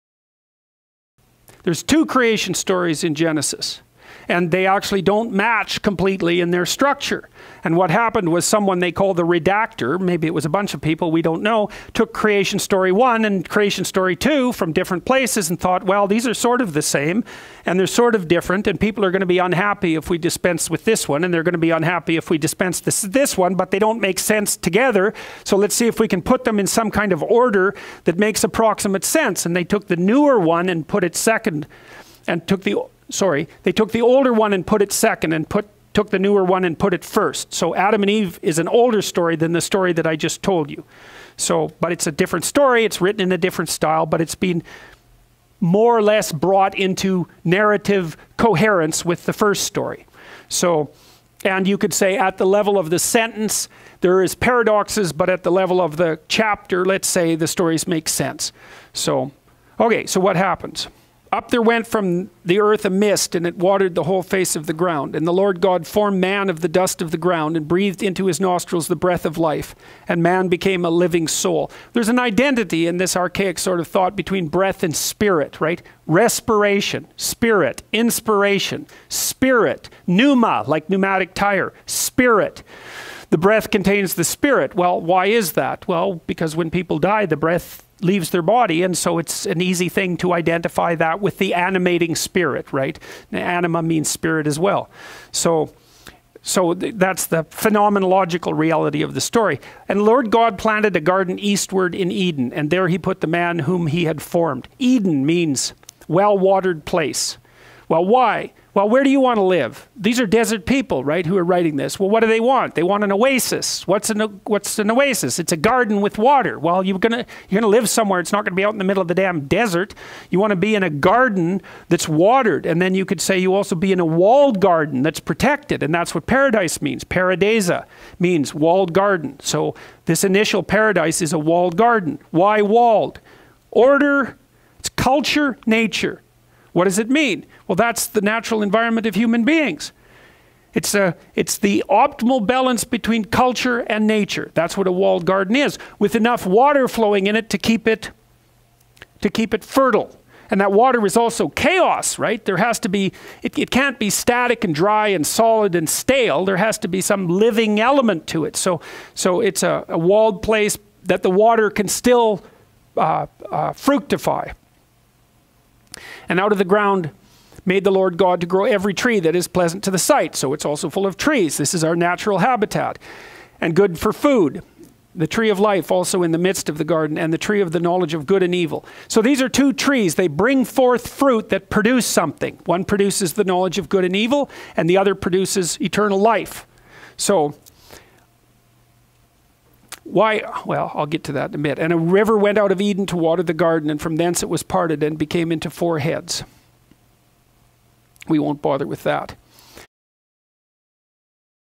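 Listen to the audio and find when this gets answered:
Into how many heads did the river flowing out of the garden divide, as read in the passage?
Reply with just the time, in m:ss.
3:15.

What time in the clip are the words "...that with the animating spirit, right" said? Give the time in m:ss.
1:30.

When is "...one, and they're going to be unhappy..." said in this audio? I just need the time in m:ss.
0:21.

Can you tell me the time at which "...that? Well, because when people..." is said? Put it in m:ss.
1:25.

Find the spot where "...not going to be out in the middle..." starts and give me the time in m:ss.
1:58.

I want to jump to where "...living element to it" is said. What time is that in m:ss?
2:37.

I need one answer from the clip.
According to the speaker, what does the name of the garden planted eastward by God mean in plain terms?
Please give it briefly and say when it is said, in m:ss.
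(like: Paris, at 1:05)
Well watered place, at 1:46.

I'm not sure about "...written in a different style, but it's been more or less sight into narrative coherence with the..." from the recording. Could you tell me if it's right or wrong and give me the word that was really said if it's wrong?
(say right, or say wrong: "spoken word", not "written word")
wrong: "brought", not "sight".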